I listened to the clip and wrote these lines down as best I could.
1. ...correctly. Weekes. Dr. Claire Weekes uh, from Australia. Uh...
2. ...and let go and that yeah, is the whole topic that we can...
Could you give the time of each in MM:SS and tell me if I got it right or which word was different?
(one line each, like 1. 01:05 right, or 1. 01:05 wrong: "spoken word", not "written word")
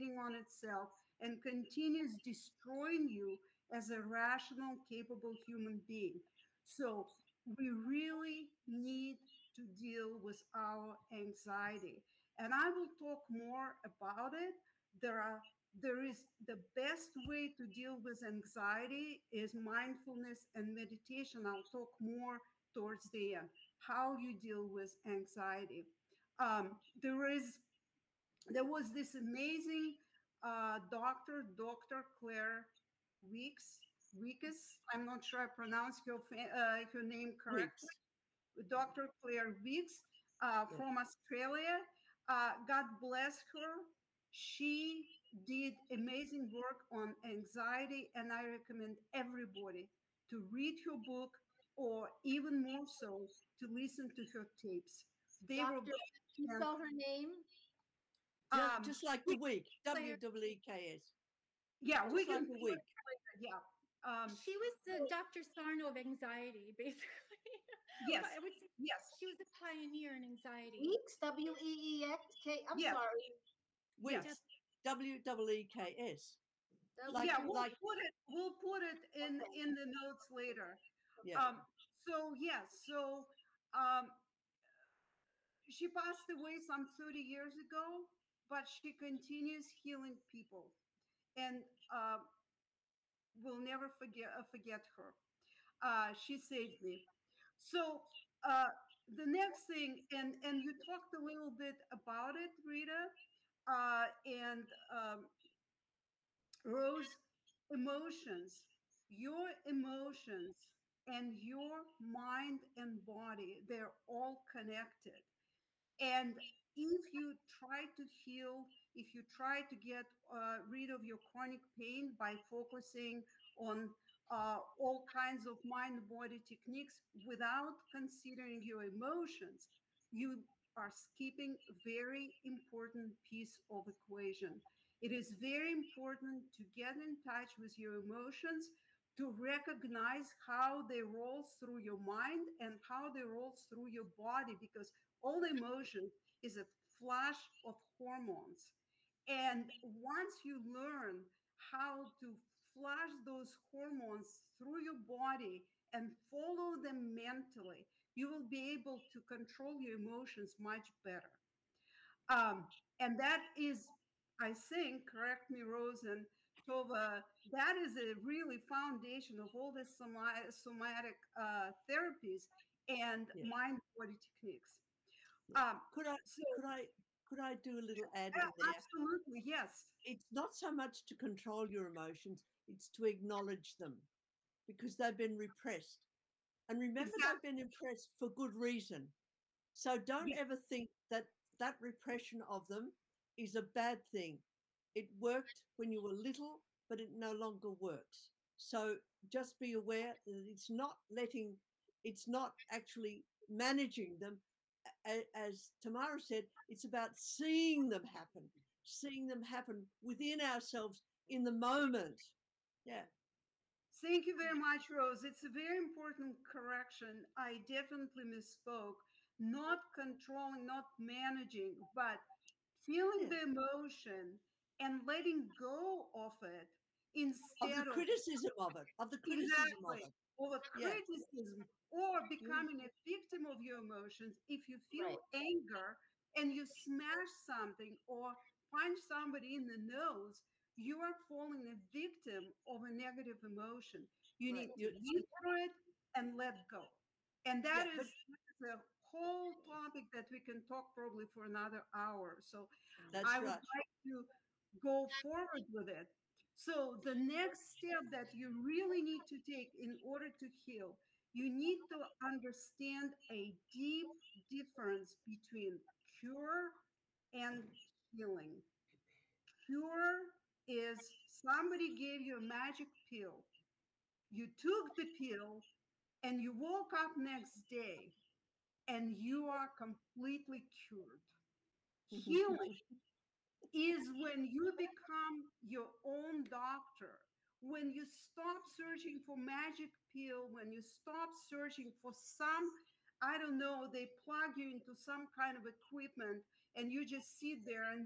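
1. 00:37 right
2. 04:06 right.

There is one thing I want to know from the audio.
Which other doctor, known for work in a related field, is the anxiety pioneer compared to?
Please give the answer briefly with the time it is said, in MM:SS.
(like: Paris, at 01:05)
Dr. Sarno, at 01:05.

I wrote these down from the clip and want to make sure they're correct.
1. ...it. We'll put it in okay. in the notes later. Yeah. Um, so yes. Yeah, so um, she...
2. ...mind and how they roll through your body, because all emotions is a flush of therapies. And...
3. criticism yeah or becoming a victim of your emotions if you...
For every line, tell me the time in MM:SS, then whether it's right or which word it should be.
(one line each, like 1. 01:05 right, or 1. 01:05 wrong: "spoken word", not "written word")
1. 01:17 right
2. 02:21 wrong: "hormones", not "therapies"
3. 03:50 right.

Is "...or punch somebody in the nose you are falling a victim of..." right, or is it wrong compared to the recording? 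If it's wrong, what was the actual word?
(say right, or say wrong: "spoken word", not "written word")
right.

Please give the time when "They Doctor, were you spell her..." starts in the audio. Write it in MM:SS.
00:55.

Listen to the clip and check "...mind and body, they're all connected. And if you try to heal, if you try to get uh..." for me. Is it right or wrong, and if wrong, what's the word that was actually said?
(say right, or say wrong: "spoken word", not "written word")
right.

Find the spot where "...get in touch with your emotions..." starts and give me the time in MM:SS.
02:16.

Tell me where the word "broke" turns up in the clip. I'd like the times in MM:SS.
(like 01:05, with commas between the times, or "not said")
not said.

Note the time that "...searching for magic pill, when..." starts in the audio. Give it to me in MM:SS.
04:48.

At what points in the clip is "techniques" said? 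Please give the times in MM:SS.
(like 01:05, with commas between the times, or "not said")
02:06, 02:54.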